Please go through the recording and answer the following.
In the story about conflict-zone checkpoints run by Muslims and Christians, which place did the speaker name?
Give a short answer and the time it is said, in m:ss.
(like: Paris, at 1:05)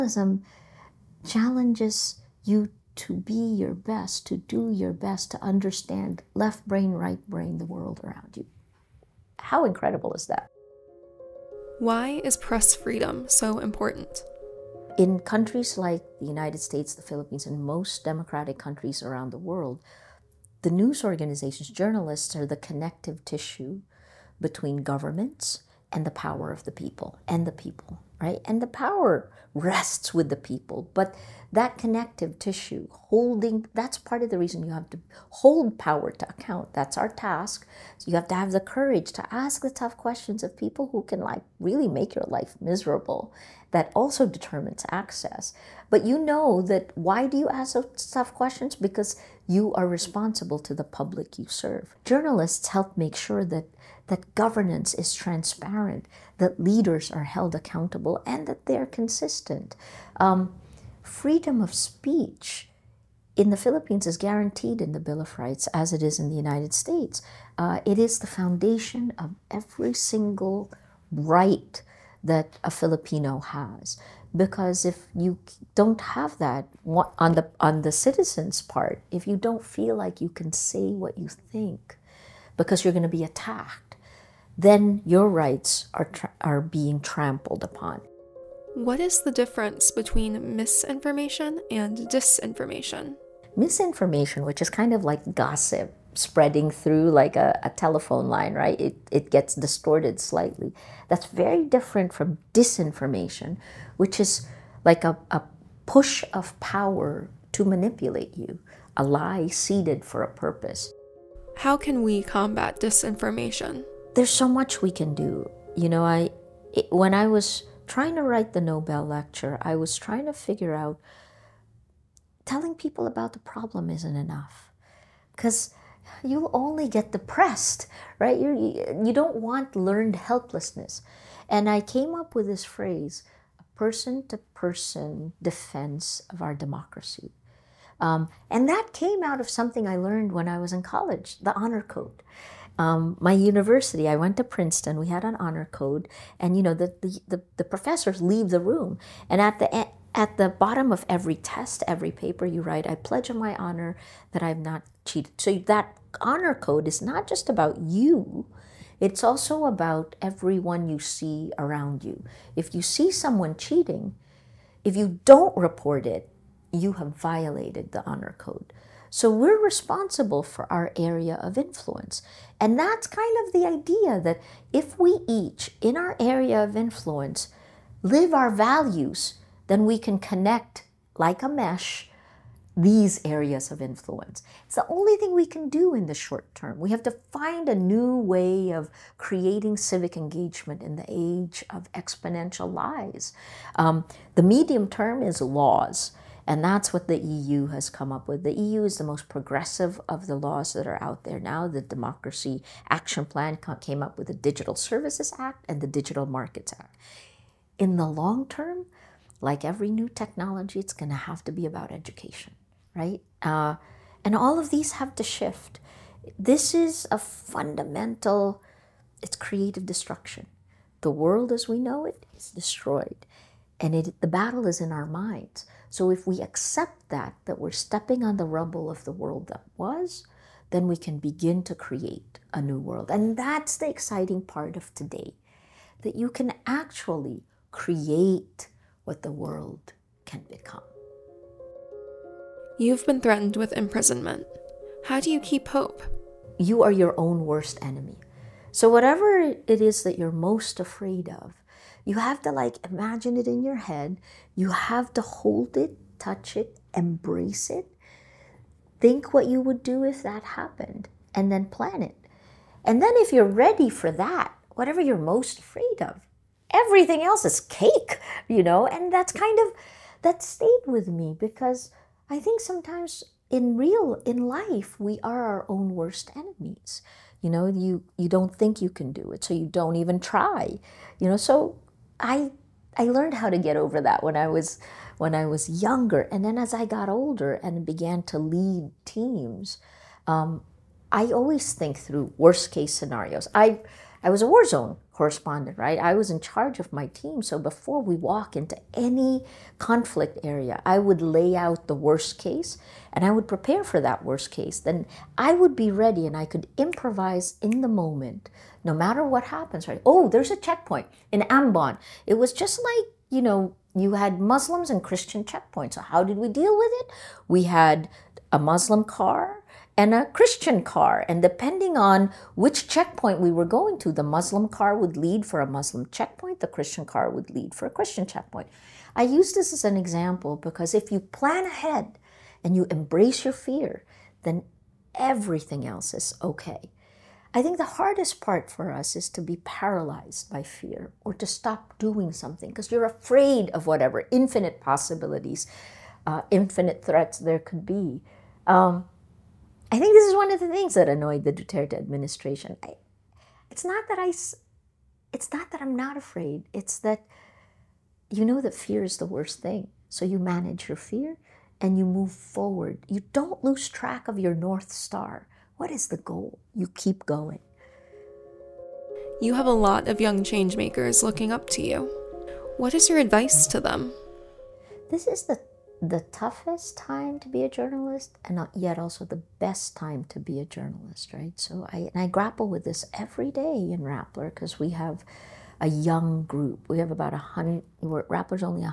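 Ambon, at 5:11.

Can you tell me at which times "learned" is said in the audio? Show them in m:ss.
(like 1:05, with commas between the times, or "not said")
2:09, 2:19, 4:43.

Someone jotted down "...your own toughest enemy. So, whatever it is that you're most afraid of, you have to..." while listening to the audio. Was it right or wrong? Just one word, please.
wrong.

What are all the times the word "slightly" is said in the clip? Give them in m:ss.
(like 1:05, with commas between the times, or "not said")
1:40.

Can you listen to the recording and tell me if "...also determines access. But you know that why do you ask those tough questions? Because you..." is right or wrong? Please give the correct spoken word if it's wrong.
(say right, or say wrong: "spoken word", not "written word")
right.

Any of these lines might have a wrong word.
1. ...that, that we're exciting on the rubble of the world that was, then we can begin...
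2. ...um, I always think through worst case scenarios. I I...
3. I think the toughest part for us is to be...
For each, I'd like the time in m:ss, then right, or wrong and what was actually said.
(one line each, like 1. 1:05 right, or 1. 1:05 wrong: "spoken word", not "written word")
1. 3:47 wrong: "stepping", not "exciting"
2. 4:50 right
3. 5:37 wrong: "hardest", not "toughest".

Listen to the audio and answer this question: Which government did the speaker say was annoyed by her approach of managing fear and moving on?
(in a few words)
Duterte administration.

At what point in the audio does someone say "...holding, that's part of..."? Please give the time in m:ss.
0:32.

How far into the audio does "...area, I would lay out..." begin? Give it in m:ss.
5:00.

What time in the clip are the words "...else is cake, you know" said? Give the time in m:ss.
4:27.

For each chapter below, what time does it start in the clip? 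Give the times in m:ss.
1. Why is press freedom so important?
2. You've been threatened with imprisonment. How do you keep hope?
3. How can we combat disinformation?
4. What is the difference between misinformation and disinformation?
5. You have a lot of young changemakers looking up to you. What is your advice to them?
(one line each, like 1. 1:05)
1. 0:10
2. 4:02
3. 1:50
4. 1:28
5. 6:08.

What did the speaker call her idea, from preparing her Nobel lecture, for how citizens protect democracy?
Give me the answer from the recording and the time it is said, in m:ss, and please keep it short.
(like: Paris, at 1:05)
person to person defense, at 2:13.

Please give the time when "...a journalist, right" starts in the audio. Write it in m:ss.
6:20.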